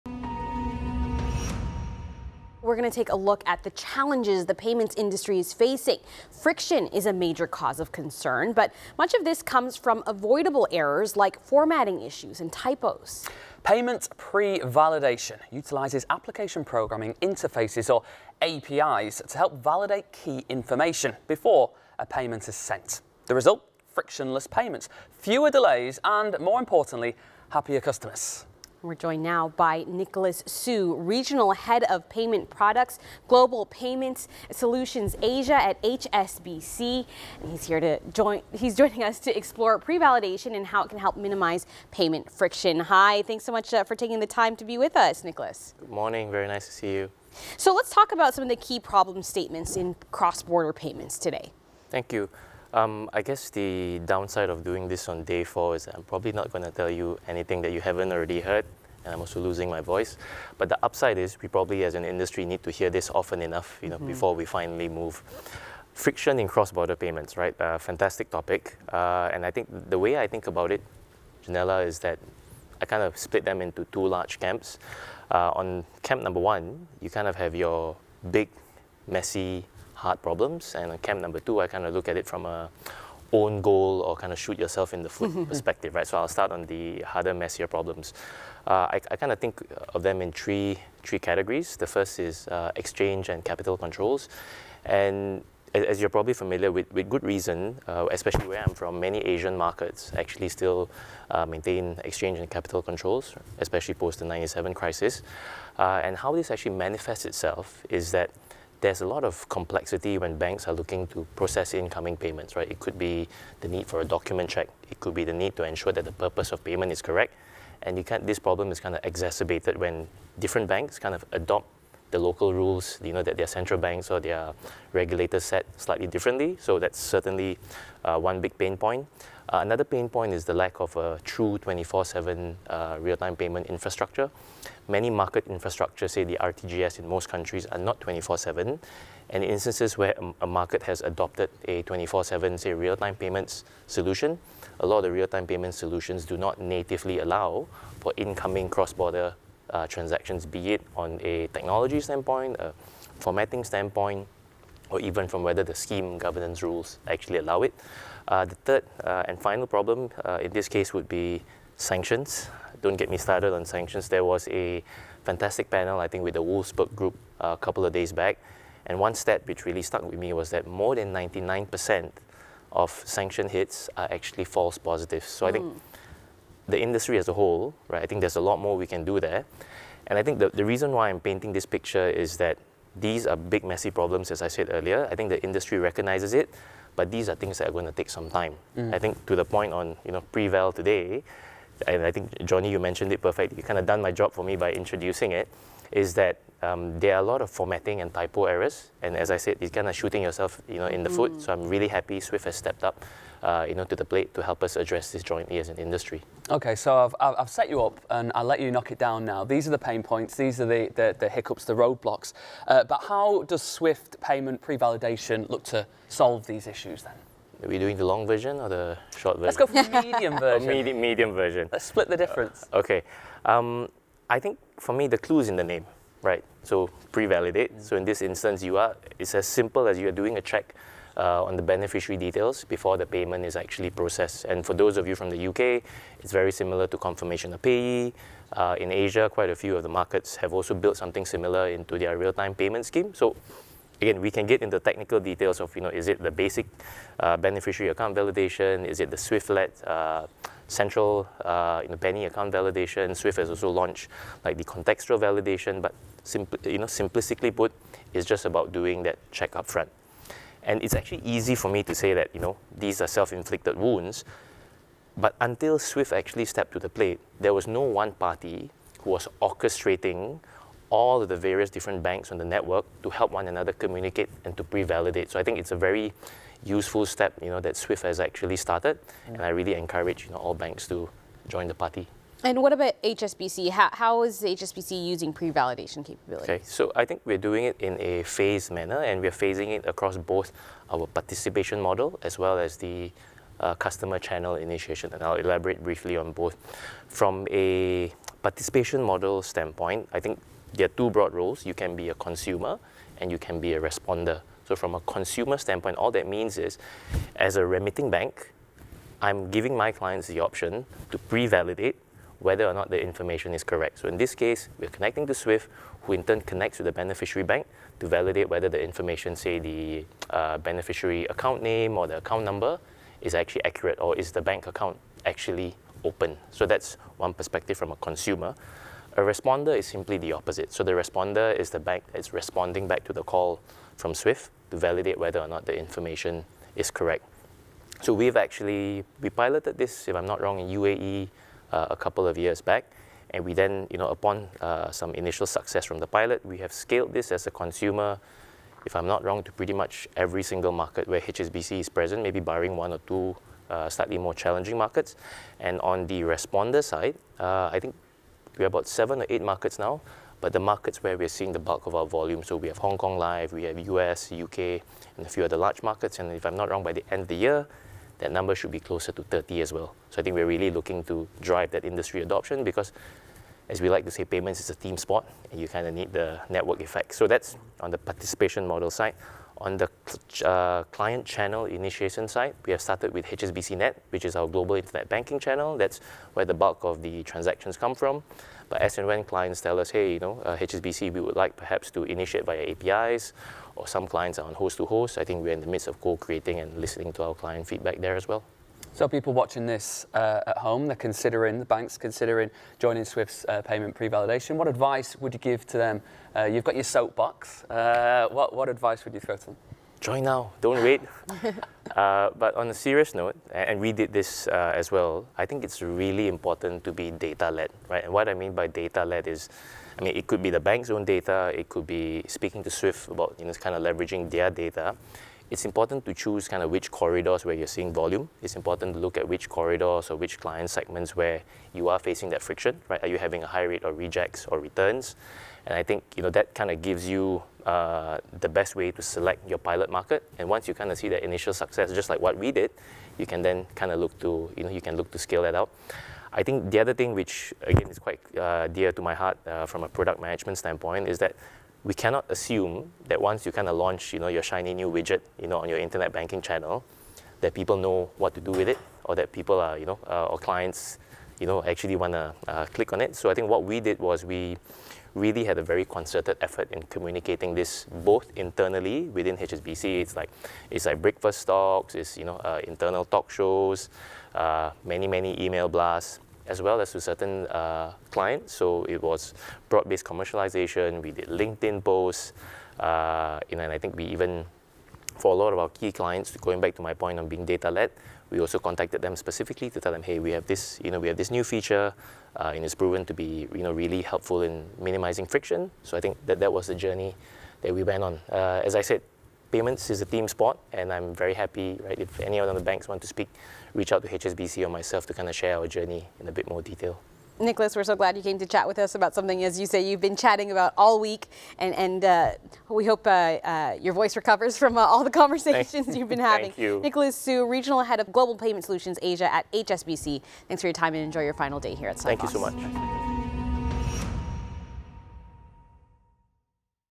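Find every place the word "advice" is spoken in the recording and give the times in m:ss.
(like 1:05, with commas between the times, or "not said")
6:44, 6:48.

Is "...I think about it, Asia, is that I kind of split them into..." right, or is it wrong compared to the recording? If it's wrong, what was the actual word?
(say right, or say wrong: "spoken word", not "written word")
wrong: "Janella", not "Asia".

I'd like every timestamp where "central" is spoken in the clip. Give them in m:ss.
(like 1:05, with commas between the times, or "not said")
2:03, 4:10.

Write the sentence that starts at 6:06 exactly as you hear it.
And if I'm not wrong, by the end of the year, that number should be closer to 30 as well.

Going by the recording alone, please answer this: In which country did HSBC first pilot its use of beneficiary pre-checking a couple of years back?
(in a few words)
UAE.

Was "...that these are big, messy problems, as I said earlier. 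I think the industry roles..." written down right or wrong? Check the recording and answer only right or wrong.
wrong.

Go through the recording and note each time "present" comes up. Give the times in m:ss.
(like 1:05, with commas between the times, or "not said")
5:51.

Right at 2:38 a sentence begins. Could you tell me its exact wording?
Uh, the third uh, and final problem uh, in this case would be sanctions.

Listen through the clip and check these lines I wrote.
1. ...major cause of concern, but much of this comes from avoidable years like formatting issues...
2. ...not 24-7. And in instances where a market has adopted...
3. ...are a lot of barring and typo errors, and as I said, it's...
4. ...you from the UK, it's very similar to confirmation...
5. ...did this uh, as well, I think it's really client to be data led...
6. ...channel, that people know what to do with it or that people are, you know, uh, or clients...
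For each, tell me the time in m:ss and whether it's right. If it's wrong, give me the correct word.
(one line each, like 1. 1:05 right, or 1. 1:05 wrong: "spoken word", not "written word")
1. 0:07 wrong: "errors", not "years"
2. 2:17 right
3. 3:17 wrong: "formatting", not "barring"
4. 3:55 right
5. 6:53 wrong: "important", not "client"
6. 7:36 right.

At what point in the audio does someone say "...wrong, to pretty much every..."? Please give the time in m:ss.
5:49.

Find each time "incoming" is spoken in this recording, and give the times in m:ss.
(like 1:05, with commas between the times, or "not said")
1:51, 2:28.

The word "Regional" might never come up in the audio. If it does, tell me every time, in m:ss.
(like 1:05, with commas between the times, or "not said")
0:30, 8:37.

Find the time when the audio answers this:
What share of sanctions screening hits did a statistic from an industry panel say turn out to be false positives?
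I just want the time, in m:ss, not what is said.
2:50.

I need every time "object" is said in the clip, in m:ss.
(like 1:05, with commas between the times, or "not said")
not said.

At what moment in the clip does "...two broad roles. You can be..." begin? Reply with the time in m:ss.
5:00.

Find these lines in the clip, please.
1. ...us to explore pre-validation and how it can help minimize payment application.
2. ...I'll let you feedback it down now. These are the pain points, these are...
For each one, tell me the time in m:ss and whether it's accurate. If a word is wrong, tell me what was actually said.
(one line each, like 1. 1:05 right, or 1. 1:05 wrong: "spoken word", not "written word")
1. 0:39 wrong: "friction", not "application"
2. 3:28 wrong: "knock", not "feedback".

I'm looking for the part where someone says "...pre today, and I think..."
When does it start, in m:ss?
3:10.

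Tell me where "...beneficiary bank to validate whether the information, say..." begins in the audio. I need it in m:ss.
5:16.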